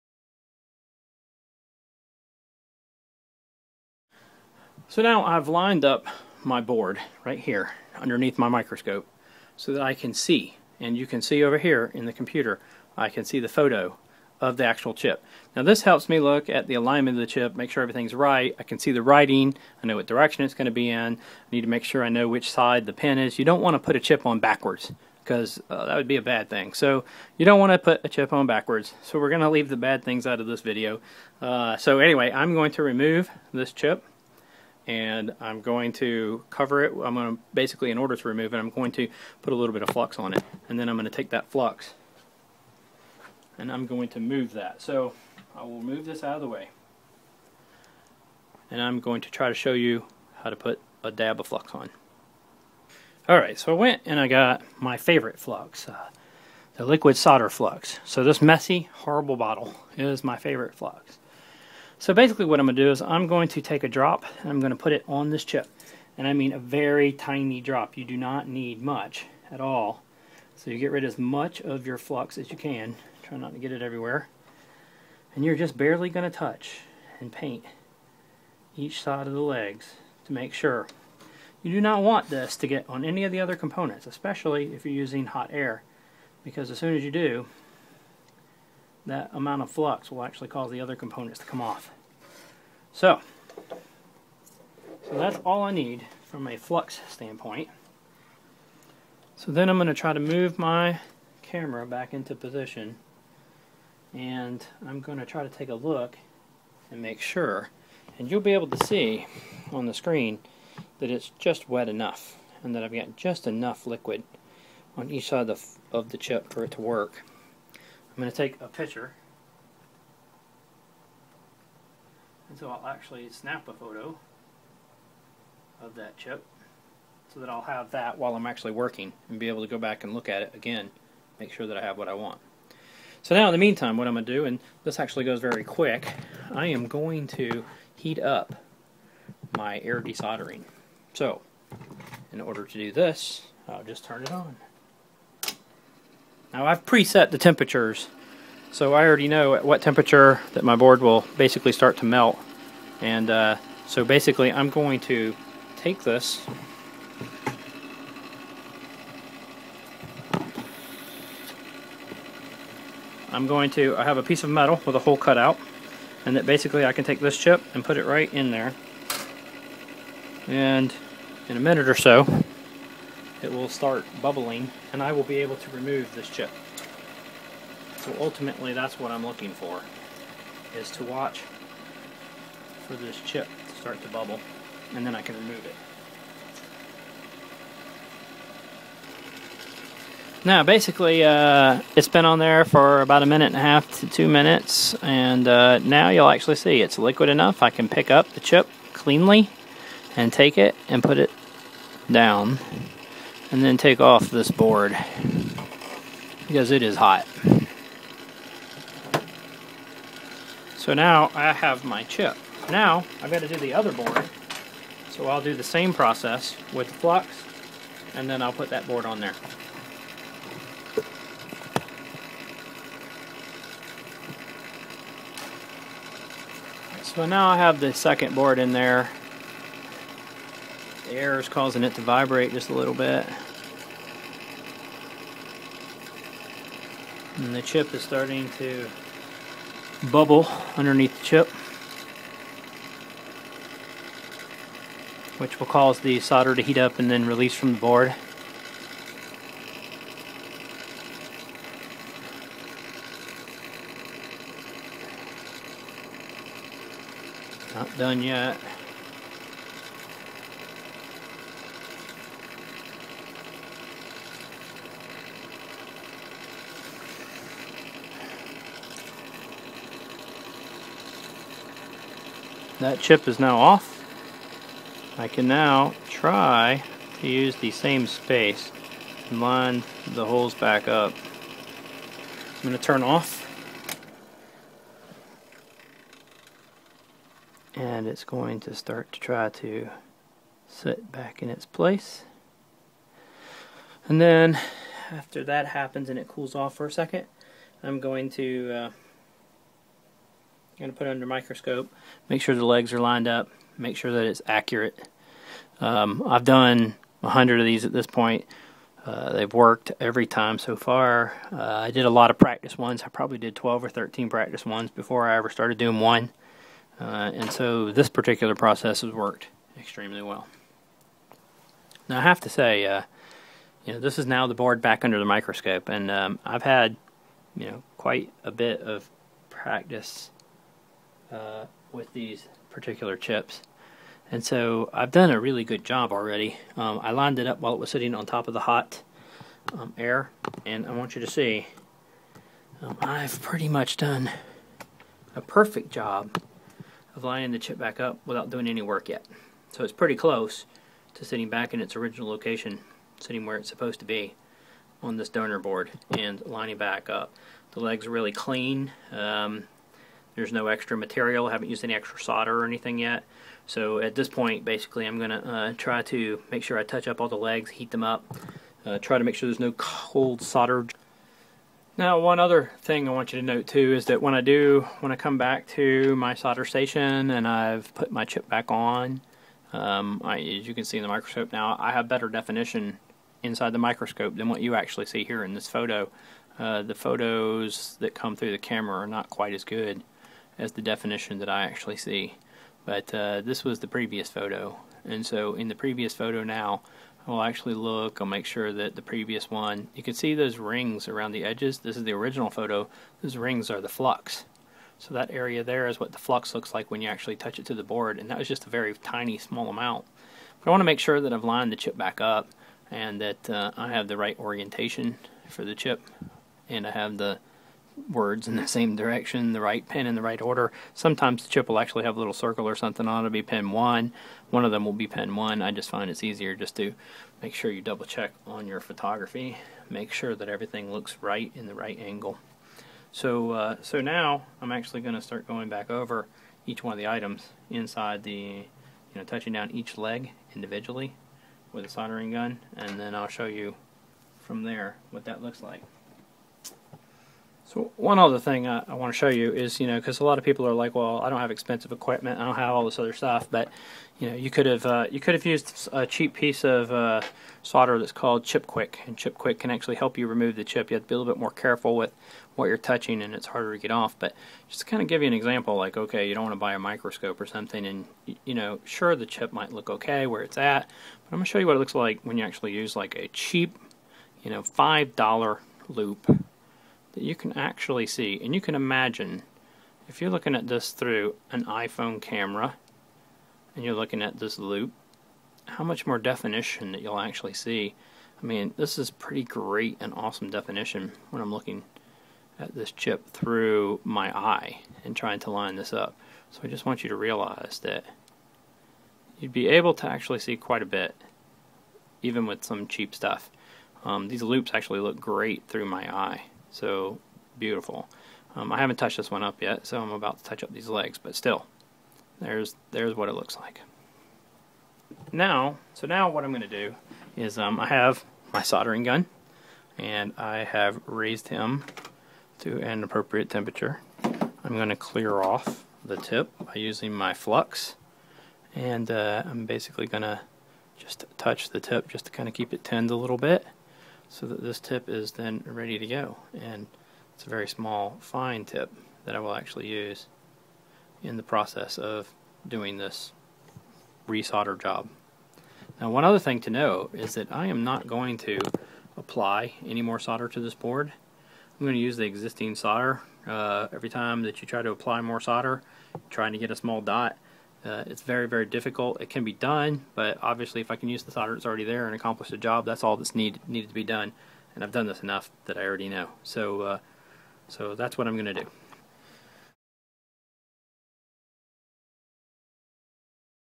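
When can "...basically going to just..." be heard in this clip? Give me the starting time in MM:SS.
08:49.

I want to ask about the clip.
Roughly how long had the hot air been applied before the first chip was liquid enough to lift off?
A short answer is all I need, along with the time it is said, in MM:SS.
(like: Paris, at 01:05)
About a minute and a half to two minutes, at 03:13.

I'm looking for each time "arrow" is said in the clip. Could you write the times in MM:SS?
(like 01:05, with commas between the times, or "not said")
not said.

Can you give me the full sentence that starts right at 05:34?
And so I've done a really good job already.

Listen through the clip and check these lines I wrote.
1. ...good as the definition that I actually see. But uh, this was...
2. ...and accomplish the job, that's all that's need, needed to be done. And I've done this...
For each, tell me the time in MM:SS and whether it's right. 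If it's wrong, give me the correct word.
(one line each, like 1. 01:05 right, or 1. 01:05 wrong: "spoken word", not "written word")
1. 06:29 right
2. 09:22 right.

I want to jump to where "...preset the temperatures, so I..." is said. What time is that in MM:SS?
02:26.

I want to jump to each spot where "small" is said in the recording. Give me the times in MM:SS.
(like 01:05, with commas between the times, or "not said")
06:49, 08:57, 09:16.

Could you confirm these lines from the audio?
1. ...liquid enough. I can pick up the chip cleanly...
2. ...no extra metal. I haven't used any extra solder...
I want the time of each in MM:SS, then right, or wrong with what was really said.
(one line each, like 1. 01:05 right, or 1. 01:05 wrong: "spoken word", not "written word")
1. 03:16 right
2. 06:00 wrong: "material", not "metal".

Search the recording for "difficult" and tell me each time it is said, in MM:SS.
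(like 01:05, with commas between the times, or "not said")
09:18.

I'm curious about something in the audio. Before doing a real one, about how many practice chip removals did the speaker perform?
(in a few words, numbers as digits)
12 or 13.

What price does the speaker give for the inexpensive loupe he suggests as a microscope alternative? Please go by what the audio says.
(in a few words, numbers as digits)
$5.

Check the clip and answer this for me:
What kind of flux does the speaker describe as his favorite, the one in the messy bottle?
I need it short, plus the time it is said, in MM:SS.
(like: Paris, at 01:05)
Liquid solder flux, at 00:56.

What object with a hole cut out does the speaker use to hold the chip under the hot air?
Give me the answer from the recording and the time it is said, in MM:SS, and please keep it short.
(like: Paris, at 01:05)
A piece of metal, at 02:44.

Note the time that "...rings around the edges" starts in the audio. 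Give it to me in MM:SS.
06:40.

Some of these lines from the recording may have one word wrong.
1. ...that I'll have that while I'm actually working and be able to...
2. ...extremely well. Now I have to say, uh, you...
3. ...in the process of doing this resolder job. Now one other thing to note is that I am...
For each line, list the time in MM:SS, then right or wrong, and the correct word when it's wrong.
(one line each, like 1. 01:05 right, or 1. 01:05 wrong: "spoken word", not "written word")
1. 02:07 right
2. 05:19 right
3. 09:01 right.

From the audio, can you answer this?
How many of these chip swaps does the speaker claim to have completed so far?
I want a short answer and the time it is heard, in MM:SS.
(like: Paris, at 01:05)
100, at 05:07.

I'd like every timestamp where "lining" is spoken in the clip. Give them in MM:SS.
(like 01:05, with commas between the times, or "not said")
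05:47, 05:56.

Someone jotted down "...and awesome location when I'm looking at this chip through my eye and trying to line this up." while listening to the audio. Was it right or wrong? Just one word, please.
wrong.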